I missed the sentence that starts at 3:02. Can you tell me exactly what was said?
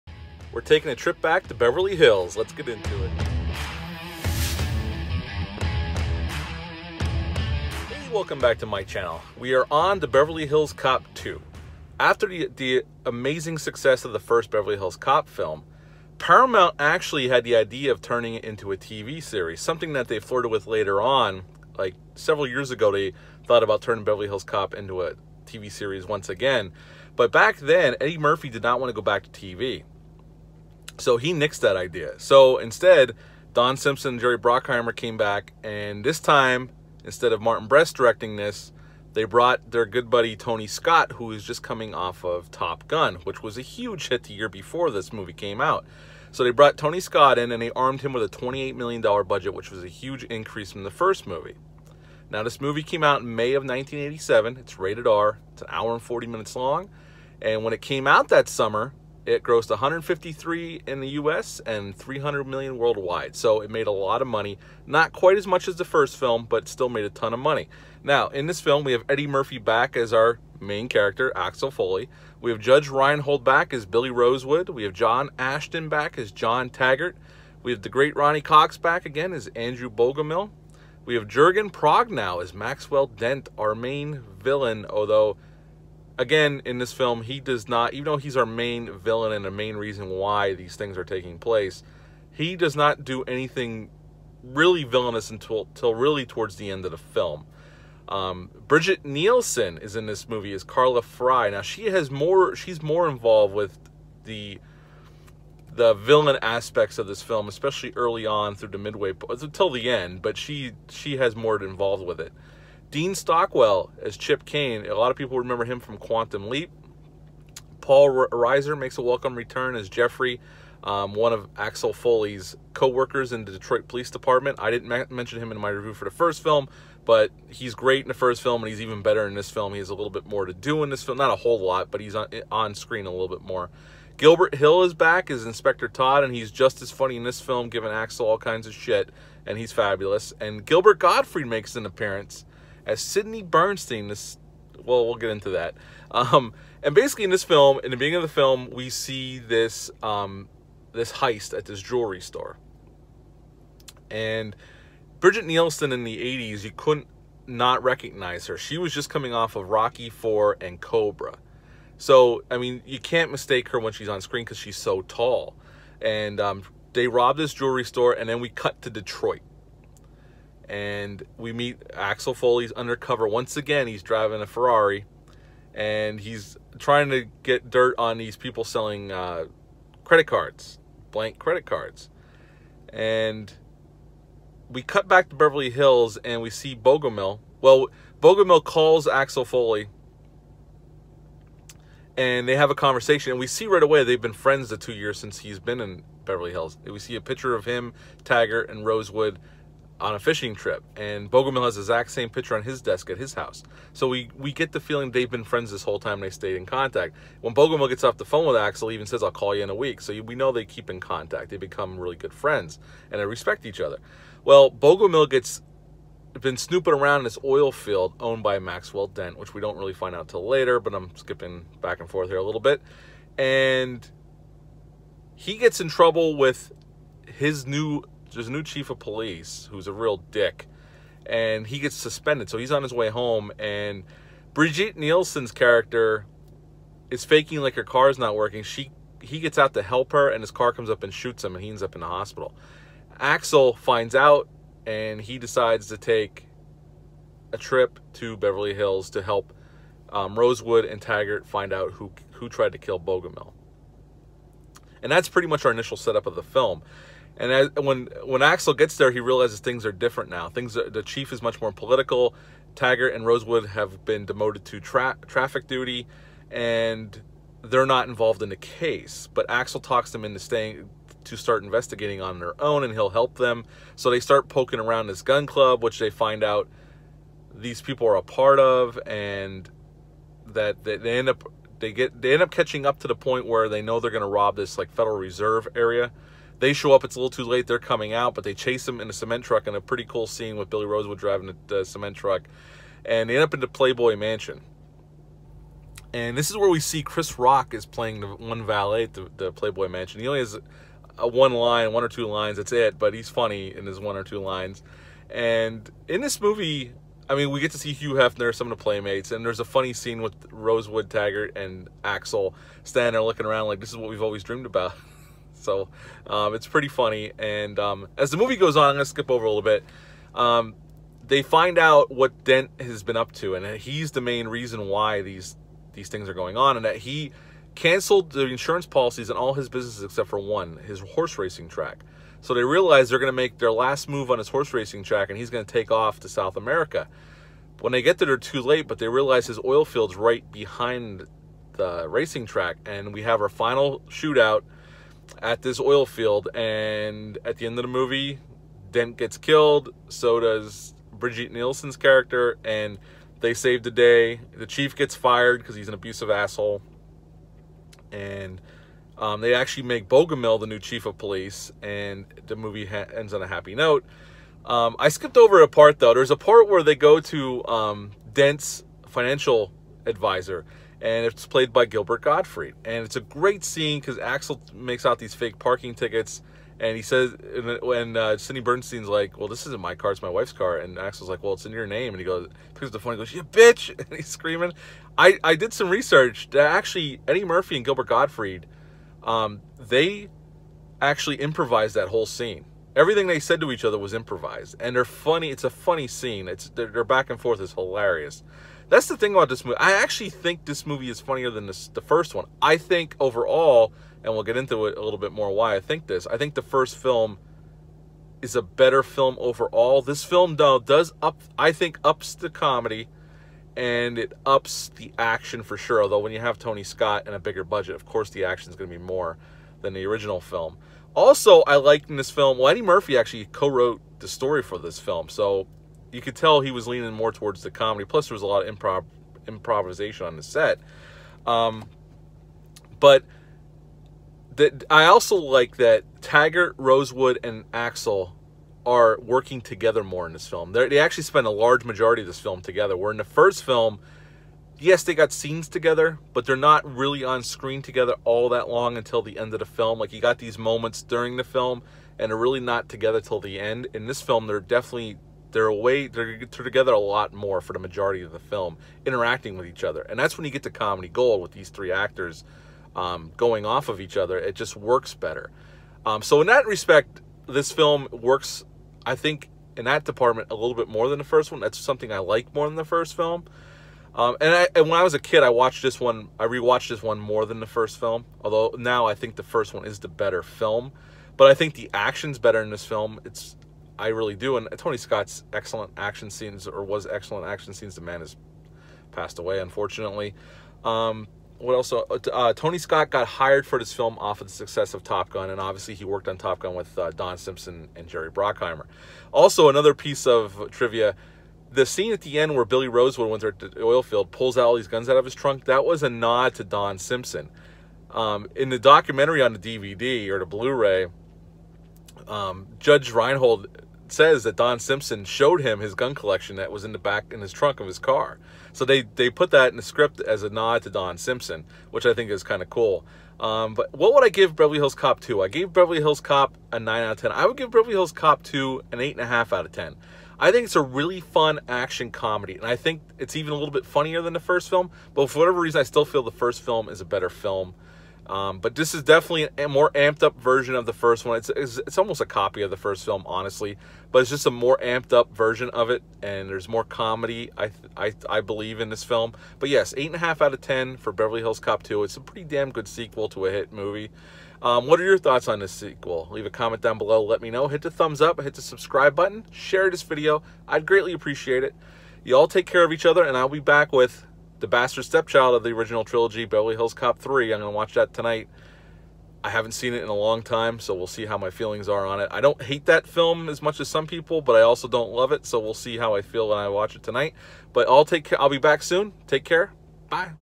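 And we cut back to Beverly Hills, and we see Bogomil.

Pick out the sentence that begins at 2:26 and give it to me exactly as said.
Um, and basically, in this film, in the beginning of the film, we see this um, this heist at this jewelry store.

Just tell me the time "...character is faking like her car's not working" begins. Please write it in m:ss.
3:55.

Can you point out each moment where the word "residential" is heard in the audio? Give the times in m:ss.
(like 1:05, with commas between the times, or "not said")
not said.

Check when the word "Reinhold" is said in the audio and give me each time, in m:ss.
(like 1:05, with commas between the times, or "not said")
1:12, 8:33.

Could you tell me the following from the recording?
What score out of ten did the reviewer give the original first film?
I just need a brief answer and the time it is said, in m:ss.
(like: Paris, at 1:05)
9, at 8:46.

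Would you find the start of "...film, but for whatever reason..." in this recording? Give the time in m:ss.
8:54.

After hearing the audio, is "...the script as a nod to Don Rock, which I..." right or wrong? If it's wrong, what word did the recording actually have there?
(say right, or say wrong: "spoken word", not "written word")
wrong: "Simpson", not "Rock".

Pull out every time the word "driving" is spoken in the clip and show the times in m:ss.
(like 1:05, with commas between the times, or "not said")
2:54, 4:51.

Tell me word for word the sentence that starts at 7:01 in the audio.
Also, I liked in this film, well, Eddie Murphy actually co wrote the story for this film.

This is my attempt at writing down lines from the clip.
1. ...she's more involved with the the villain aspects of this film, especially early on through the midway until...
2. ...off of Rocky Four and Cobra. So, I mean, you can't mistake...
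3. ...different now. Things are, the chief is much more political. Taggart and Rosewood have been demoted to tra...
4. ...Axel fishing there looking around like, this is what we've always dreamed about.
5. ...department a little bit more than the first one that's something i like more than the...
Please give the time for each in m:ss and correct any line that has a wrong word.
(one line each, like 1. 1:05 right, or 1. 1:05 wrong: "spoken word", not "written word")
1. 1:42 right
2. 2:39 right
3. 4:19 right
4. 5:12 wrong: "standing", not "fishing"
5. 7:50 right.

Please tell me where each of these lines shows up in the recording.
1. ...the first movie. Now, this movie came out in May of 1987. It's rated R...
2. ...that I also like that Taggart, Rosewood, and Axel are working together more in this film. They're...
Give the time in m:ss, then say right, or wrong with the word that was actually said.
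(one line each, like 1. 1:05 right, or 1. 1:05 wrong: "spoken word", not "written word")
1. 0:50 right
2. 7:14 right.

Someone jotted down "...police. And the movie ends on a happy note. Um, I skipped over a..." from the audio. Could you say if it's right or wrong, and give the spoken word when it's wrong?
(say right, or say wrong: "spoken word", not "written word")
right.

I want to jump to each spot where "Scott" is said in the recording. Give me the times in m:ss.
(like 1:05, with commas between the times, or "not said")
0:40, 0:47, 6:56, 8:04, 8:12.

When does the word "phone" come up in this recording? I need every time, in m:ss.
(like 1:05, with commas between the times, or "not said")
3:28, 6:22.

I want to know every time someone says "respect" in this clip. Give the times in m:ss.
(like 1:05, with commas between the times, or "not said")
3:33, 7:46.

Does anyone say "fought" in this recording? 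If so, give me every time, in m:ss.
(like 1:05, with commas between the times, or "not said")
not said.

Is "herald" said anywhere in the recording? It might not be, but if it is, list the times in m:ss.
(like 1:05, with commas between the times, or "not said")
not said.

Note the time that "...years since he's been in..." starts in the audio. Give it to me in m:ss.
3:14.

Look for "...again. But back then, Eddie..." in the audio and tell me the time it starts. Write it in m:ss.
0:26.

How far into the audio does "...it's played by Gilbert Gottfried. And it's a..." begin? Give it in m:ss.
6:11.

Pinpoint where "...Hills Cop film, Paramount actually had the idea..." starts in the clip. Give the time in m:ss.
0:14.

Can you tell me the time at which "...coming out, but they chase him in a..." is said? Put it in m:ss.
4:47.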